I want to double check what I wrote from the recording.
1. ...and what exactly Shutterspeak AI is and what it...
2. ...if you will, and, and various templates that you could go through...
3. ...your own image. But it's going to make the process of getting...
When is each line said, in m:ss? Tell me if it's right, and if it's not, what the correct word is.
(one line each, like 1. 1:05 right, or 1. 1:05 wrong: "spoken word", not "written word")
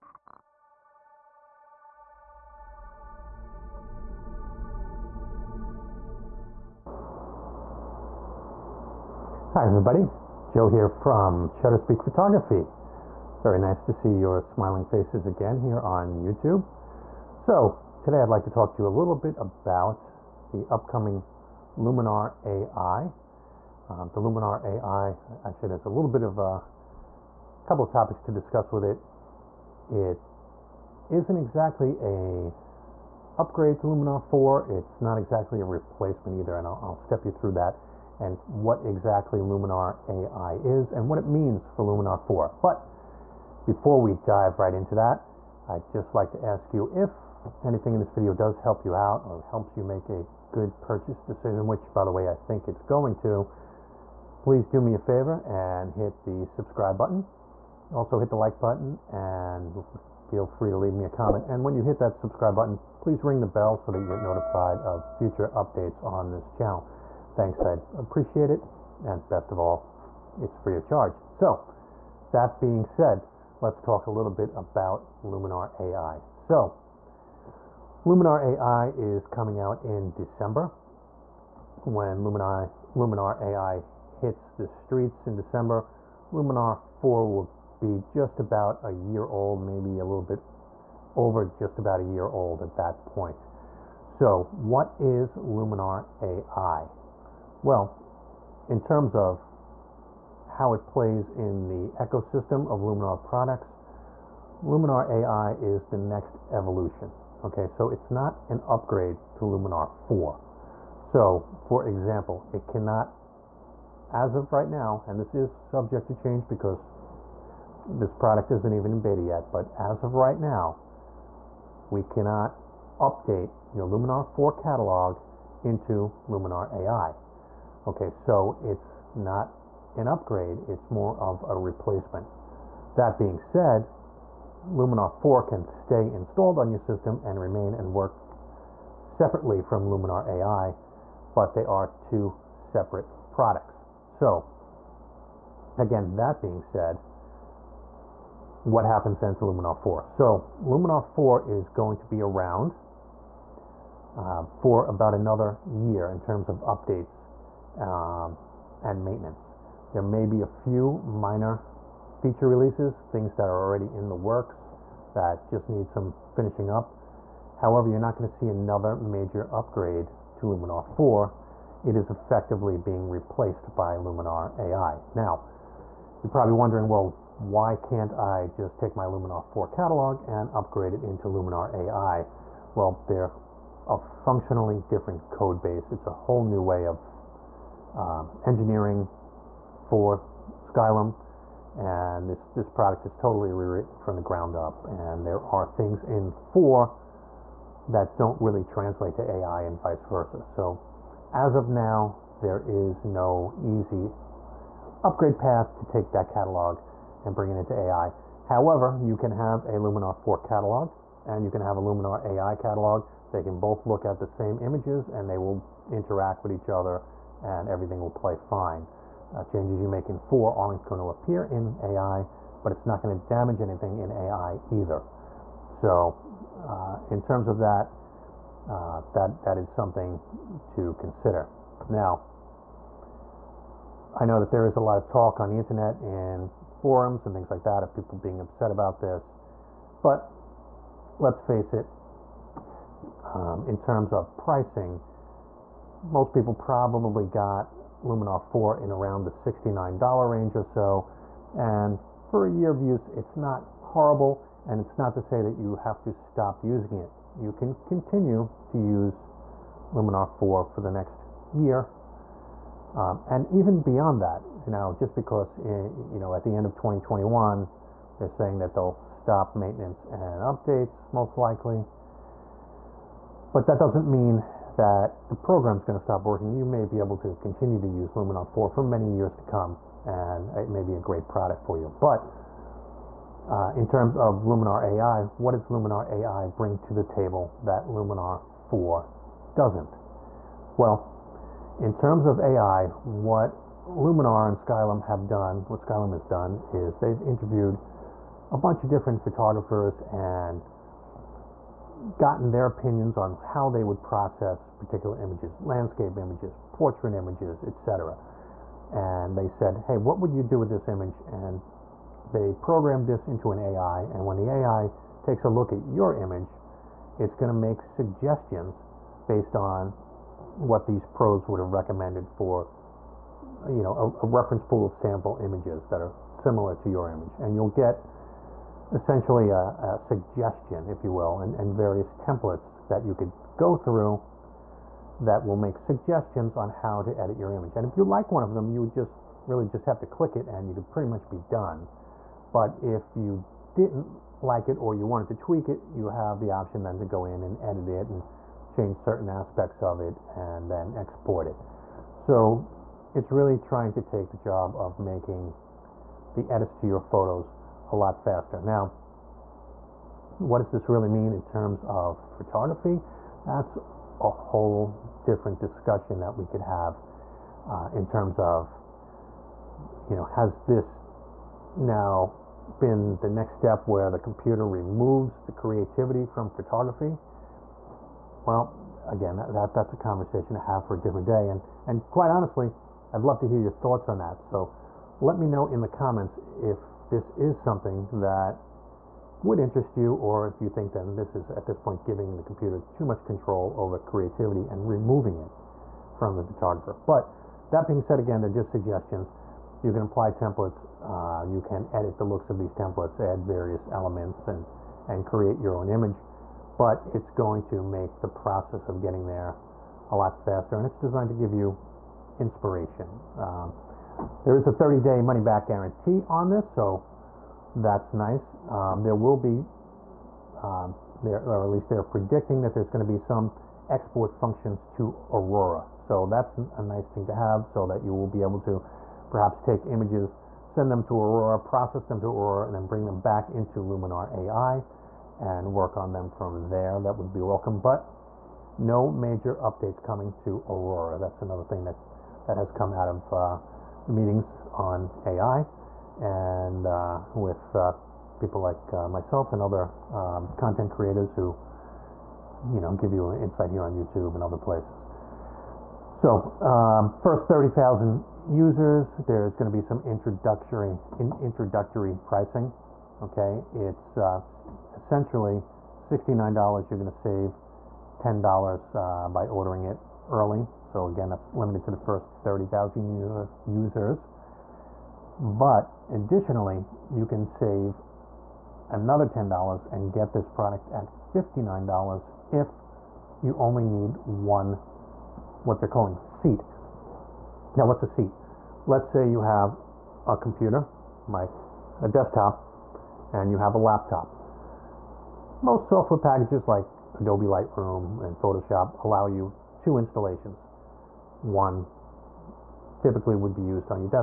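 1. 0:38 wrong: "Luminar", not "Shutterspeak"
2. 5:30 right
3. 6:45 right.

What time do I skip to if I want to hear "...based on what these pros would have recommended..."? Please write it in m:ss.
5:19.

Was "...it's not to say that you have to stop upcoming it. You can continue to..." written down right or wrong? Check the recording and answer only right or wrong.
wrong.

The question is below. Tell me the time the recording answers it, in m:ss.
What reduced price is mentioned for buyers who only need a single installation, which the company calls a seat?
8:01.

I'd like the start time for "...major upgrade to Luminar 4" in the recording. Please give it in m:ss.
2:48.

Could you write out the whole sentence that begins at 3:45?
So uh, in terms of that, uh, that, that is something to consider.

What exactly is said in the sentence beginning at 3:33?
They can both look at the same images and they will interact with each other and everything will play fine.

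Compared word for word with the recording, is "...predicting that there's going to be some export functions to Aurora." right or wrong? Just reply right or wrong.
right.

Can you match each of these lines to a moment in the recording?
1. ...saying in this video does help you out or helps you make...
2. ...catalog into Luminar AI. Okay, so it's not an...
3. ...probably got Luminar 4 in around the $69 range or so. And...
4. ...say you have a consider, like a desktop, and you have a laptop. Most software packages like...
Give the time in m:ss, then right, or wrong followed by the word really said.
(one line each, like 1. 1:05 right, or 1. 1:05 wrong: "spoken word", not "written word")
1. 0:47 wrong: "anything", not "saying"
2. 2:04 right
3. 4:06 right
4. 8:09 wrong: "computer", not "consider".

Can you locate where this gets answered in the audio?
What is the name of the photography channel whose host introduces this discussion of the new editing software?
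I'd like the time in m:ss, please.
0:11.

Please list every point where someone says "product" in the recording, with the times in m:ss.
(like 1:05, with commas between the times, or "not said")
1:43, 1:58, 2:23, 3:12, 4:41, 8:00.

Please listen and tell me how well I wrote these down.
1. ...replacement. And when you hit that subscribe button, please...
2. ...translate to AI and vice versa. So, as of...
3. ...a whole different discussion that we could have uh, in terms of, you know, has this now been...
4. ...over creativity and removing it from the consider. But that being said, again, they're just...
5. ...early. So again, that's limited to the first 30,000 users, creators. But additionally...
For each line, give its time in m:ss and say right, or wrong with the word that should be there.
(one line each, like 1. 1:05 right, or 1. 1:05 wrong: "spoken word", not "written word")
1. 1:01 wrong: "comment", not "replacement"
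2. 3:18 right
3. 6:04 right
4. 6:33 wrong: "photographer", not "consider"
5. 7:50 wrong: "users", not "creators".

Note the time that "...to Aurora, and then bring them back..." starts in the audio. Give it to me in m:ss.
7:12.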